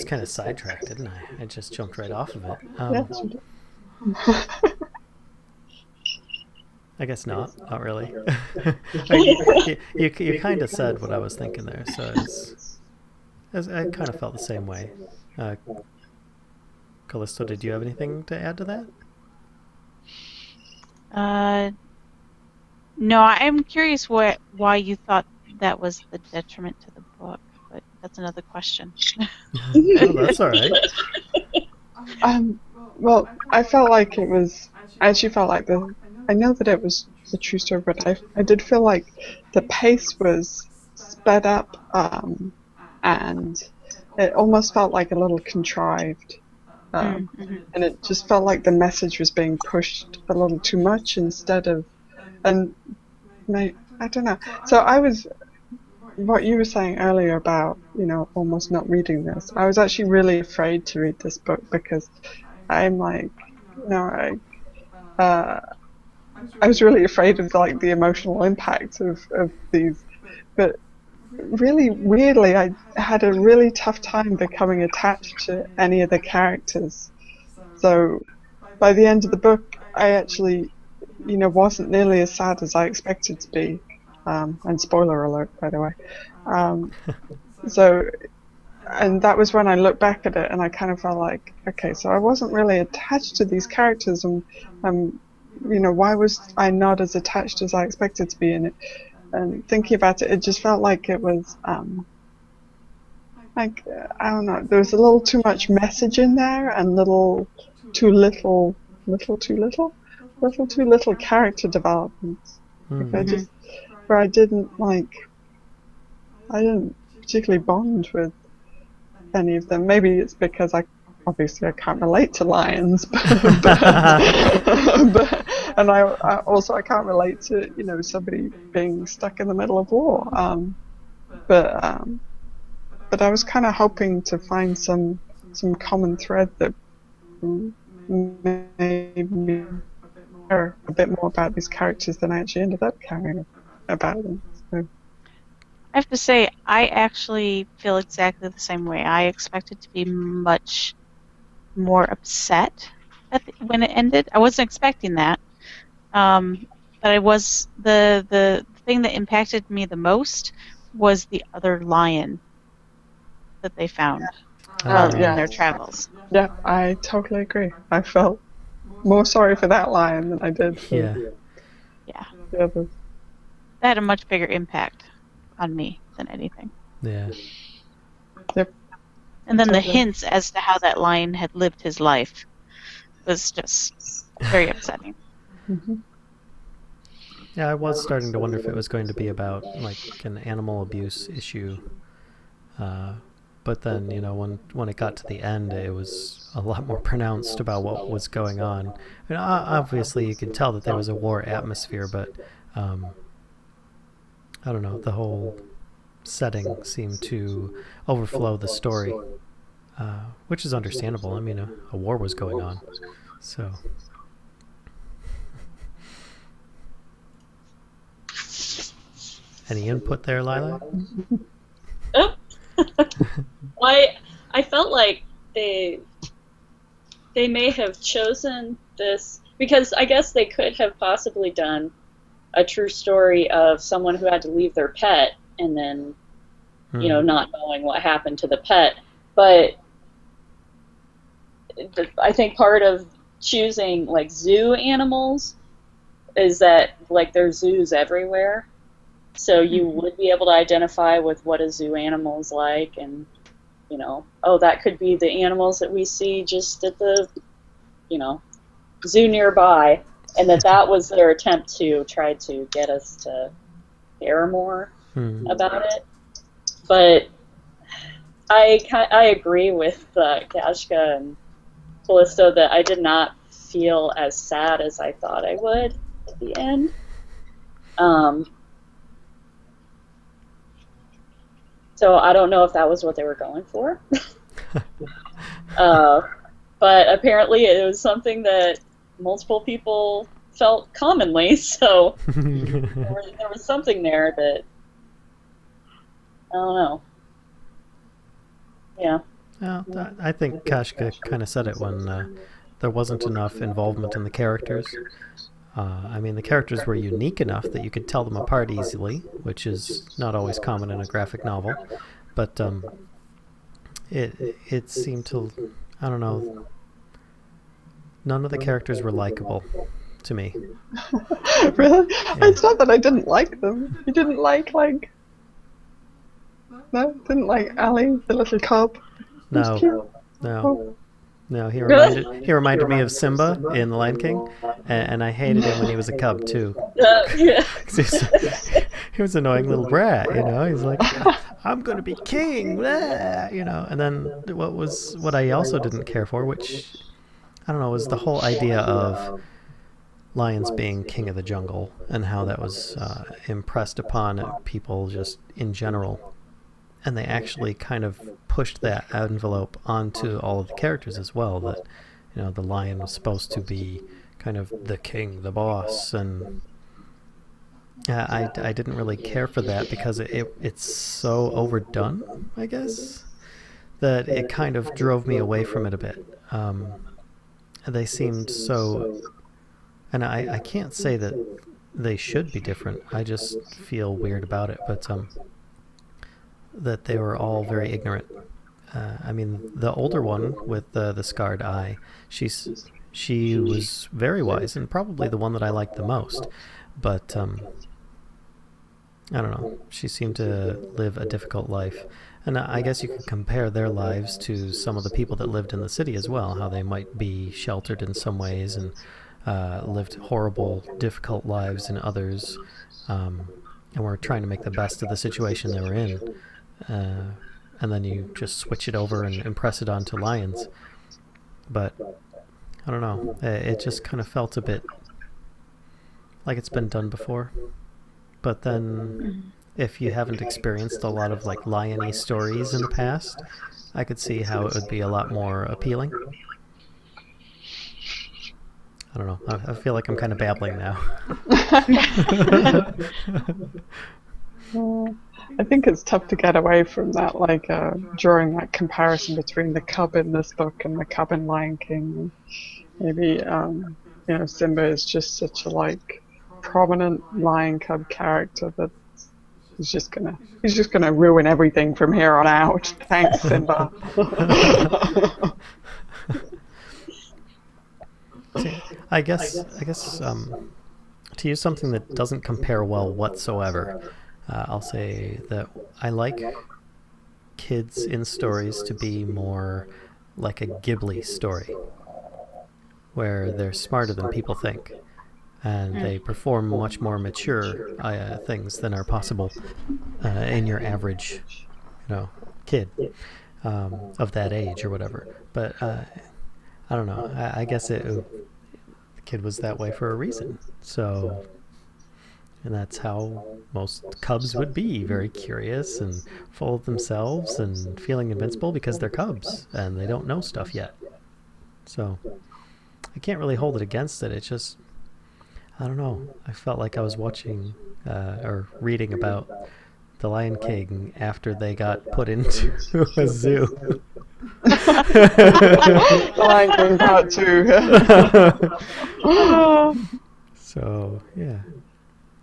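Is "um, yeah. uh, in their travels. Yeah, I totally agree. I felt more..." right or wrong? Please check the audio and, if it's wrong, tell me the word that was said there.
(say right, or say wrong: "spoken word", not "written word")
right.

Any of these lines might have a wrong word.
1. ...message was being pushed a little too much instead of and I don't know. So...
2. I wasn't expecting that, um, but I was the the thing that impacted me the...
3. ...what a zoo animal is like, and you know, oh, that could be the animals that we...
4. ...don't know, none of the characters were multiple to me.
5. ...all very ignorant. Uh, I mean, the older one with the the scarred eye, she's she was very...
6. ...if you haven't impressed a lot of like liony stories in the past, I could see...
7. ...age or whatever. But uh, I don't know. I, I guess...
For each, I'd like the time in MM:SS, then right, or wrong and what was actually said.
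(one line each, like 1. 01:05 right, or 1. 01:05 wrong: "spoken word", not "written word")
1. 00:48 right
2. 02:34 right
3. 04:11 right
4. 05:16 wrong: "likable", not "multiple"
5. 06:27 right
6. 07:09 wrong: "experienced", not "impressed"
7. 08:14 right.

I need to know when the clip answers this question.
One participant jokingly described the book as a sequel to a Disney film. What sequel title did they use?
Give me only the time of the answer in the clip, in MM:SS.
08:46.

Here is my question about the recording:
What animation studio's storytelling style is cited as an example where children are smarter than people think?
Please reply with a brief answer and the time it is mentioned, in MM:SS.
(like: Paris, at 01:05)
Ghibli, at 08:00.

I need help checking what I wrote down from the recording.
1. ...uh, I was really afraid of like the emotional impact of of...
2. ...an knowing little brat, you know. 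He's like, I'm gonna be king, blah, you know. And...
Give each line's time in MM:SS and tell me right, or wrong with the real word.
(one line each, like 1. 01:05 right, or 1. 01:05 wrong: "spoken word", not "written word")
1. 01:05 right
2. 05:39 wrong: "annoying", not "knowing".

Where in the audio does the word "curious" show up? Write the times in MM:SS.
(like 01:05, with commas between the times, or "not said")
00:23, 08:25.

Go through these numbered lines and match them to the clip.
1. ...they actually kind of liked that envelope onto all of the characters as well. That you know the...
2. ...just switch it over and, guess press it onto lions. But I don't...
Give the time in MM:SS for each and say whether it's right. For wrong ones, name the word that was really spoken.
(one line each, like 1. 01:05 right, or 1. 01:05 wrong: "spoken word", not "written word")
1. 05:57 wrong: "pushed", not "liked"
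2. 06:58 wrong: "impress", not "guess".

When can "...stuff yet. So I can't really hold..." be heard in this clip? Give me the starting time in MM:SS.
08:30.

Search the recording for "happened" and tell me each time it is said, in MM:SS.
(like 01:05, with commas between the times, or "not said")
03:58.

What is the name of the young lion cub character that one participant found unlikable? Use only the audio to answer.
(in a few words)
Ali.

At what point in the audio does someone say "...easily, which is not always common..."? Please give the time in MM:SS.
05:08.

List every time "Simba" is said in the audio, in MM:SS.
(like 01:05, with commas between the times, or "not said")
05:33, 07:34, 07:43.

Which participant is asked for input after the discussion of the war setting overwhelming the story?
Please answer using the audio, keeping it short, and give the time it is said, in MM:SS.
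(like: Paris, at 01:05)
Lila, at 03:40.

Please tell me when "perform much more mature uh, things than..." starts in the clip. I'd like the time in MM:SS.
08:06.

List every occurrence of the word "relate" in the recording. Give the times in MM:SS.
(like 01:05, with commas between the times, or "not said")
02:02, 02:07.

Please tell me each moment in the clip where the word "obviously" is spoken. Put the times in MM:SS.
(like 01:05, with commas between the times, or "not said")
02:01, 03:19.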